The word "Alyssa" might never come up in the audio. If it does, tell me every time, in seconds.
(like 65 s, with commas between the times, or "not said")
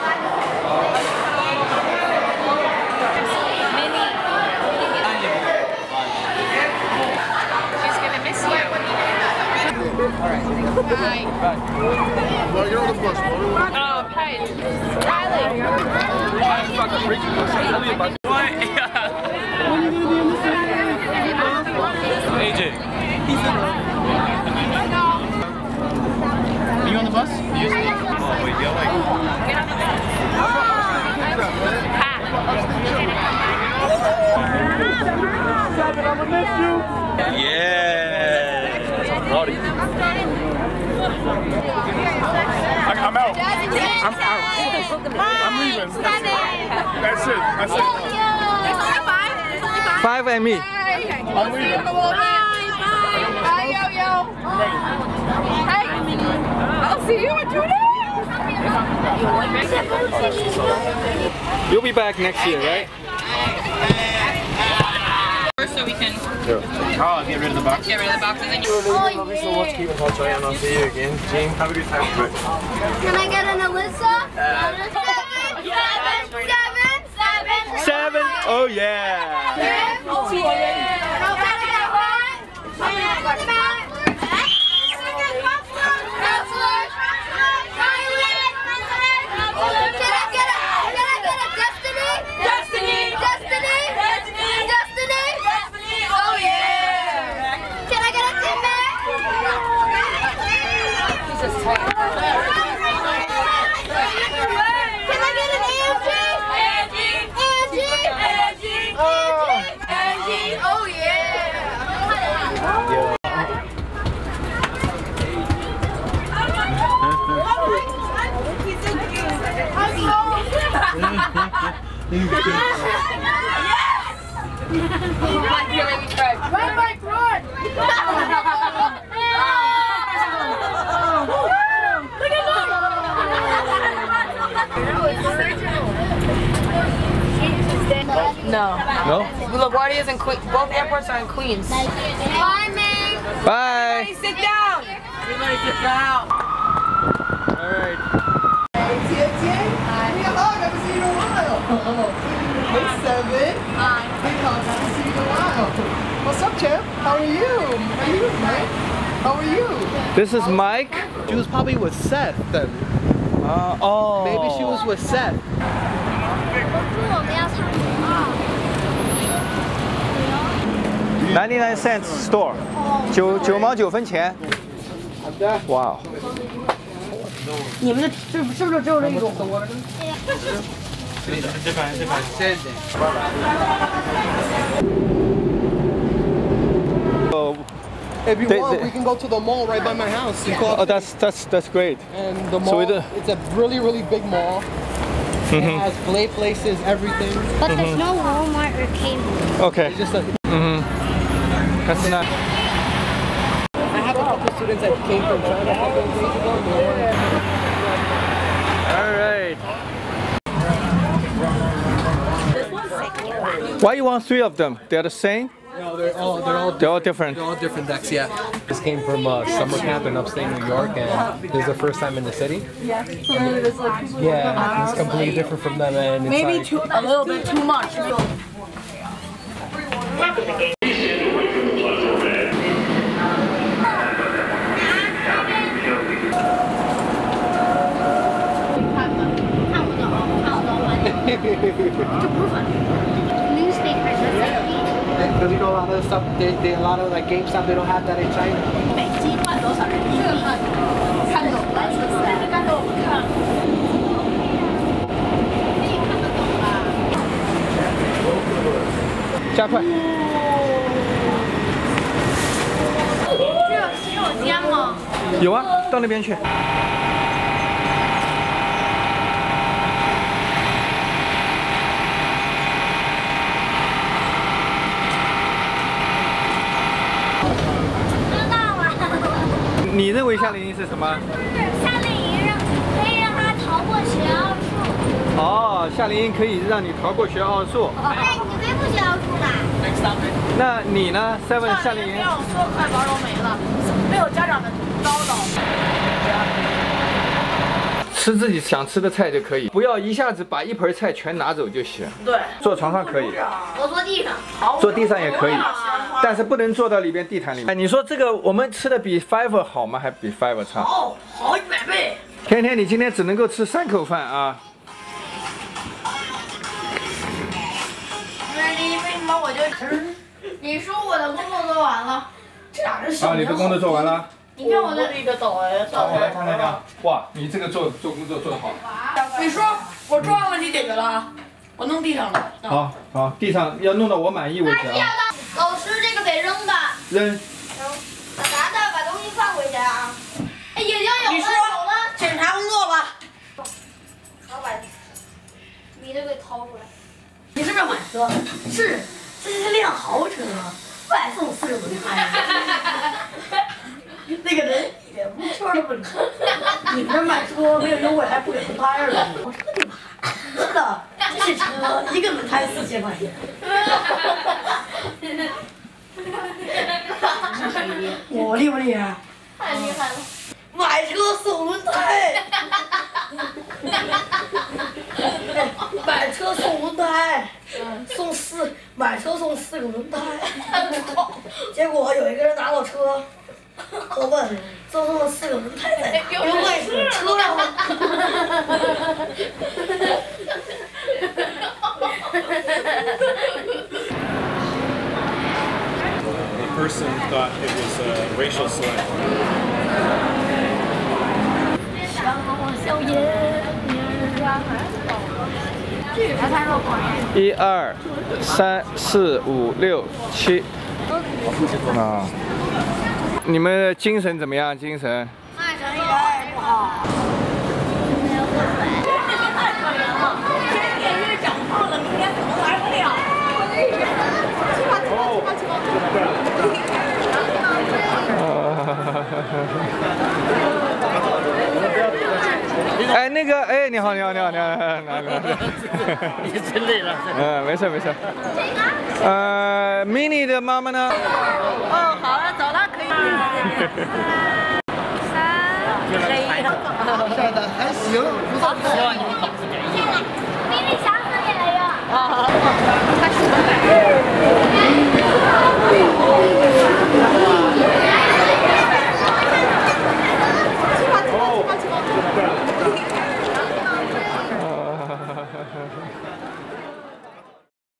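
73 s.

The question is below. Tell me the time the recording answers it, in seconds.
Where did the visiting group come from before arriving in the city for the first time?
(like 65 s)
219 s.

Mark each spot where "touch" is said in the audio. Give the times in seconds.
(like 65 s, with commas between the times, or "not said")
69 s.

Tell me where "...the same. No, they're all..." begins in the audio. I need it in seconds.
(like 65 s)
215 s.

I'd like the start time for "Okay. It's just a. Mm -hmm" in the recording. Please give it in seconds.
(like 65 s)
199 s.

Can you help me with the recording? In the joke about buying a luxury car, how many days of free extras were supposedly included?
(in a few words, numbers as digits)
45.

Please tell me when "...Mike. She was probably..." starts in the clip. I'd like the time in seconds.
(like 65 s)
160 s.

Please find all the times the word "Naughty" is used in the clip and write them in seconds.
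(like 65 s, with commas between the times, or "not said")
39 s.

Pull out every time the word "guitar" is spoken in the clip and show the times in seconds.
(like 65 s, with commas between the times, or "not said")
not said.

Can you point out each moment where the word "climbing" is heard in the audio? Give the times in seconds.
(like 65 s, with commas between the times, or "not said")
not said.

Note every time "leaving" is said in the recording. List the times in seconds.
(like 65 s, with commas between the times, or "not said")
45 s, 51 s.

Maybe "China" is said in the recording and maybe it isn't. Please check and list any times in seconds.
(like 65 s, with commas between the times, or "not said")
205 s.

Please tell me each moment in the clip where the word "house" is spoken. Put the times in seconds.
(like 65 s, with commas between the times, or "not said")
190 s.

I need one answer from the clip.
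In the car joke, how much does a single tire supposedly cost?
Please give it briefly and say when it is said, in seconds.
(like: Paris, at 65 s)
4000 yuan, at 362 s.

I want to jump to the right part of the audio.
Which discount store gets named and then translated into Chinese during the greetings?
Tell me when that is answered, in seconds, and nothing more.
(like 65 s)
171 s.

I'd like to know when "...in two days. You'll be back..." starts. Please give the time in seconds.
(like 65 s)
57 s.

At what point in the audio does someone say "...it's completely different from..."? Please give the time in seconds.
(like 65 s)
224 s.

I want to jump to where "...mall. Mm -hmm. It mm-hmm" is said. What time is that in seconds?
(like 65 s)
194 s.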